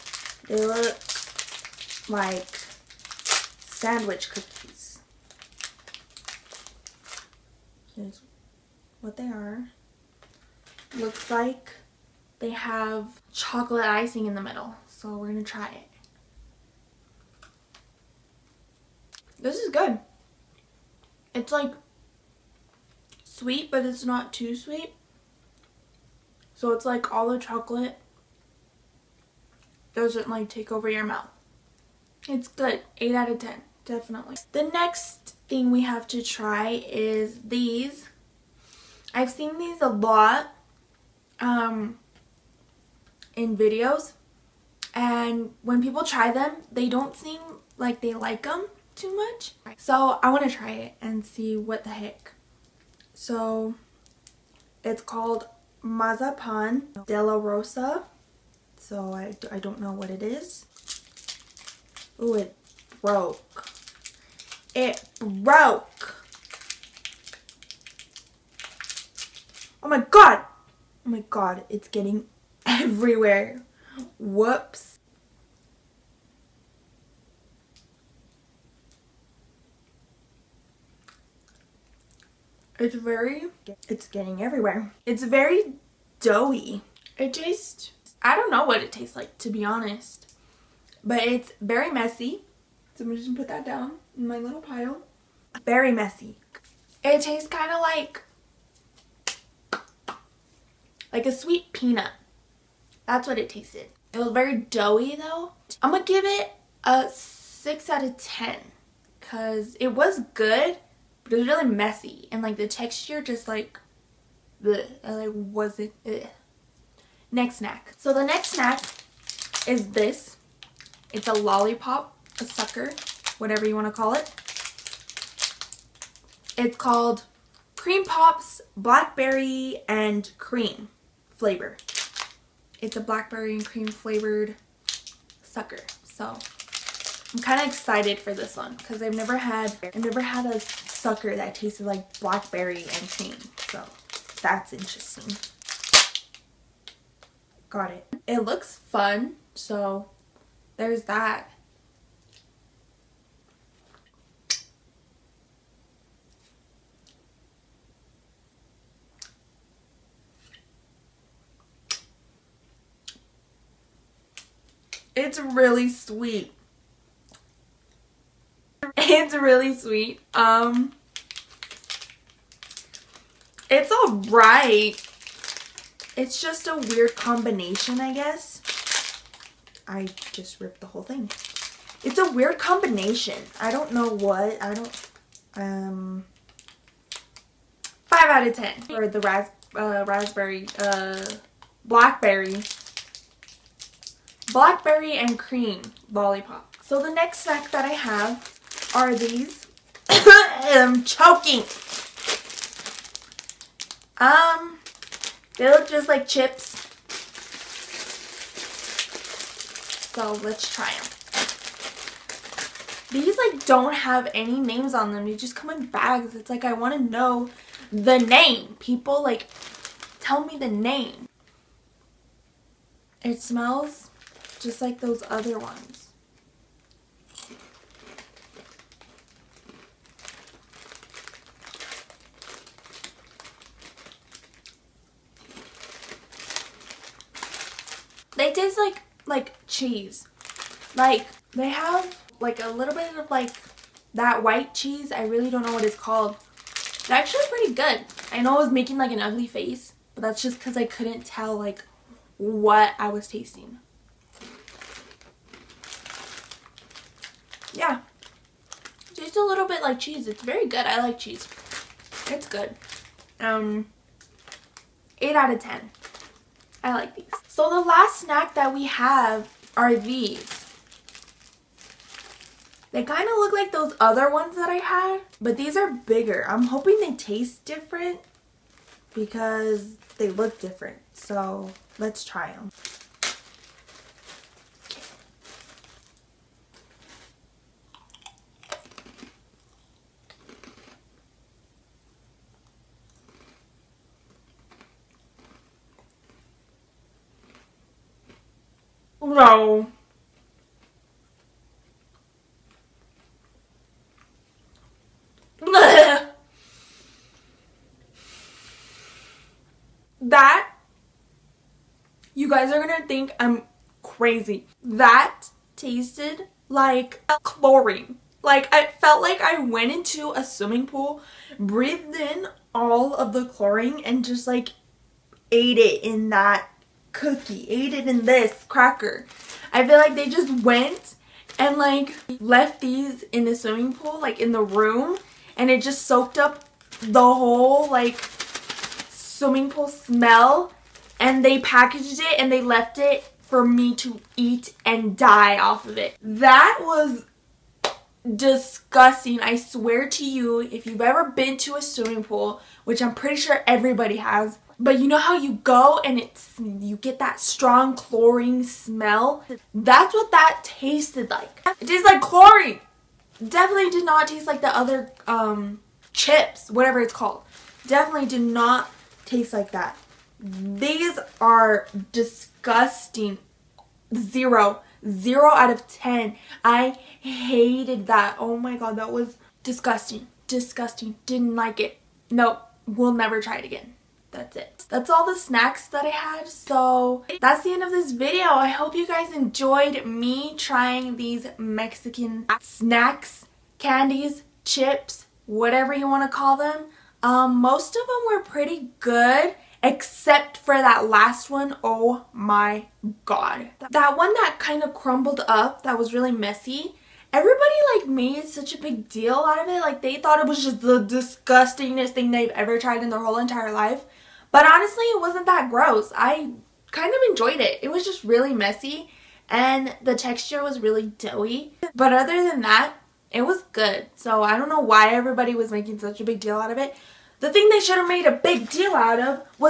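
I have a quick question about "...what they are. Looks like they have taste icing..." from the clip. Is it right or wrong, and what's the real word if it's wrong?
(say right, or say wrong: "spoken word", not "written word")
wrong: "chocolate", not "taste".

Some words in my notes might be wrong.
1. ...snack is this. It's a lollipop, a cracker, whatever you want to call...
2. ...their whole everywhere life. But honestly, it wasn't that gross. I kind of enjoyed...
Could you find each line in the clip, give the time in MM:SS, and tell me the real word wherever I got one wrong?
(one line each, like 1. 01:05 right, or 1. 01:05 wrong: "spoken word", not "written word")
1. 01:58 wrong: "sucker", not "cracker"
2. 06:53 wrong: "entire", not "everywhere".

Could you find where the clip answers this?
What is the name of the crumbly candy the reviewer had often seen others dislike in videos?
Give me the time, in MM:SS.
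00:55.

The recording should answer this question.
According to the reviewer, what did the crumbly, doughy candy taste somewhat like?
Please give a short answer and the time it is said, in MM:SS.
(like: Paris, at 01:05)
A sweet peanut, at 01:41.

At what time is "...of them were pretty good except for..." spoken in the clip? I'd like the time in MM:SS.
06:37.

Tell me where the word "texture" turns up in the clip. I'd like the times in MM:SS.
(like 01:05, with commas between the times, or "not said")
01:52, 07:00.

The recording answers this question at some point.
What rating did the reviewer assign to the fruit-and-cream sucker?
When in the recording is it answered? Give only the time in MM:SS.
03:08.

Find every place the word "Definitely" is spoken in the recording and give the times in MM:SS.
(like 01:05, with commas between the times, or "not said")
00:33, 06:03, 06:07.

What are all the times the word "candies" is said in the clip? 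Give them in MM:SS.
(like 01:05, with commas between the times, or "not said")
06:33.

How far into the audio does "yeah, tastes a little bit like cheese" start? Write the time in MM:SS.
04:17.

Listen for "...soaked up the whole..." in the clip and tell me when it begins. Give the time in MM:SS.
05:36.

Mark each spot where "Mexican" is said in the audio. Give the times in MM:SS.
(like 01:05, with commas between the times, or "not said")
06:31.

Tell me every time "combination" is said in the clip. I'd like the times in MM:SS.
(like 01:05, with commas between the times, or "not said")
02:57, 03:02.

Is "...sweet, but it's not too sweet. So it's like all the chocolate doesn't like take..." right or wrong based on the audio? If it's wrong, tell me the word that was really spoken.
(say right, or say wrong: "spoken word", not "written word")
right.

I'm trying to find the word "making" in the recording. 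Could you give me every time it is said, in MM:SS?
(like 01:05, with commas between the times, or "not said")
04:08, 07:05.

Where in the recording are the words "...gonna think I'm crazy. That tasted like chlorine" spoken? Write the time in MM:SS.
05:12.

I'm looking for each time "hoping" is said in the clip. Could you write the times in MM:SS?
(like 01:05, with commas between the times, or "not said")
04:36.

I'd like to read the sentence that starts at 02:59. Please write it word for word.
I just ripped the whole thing.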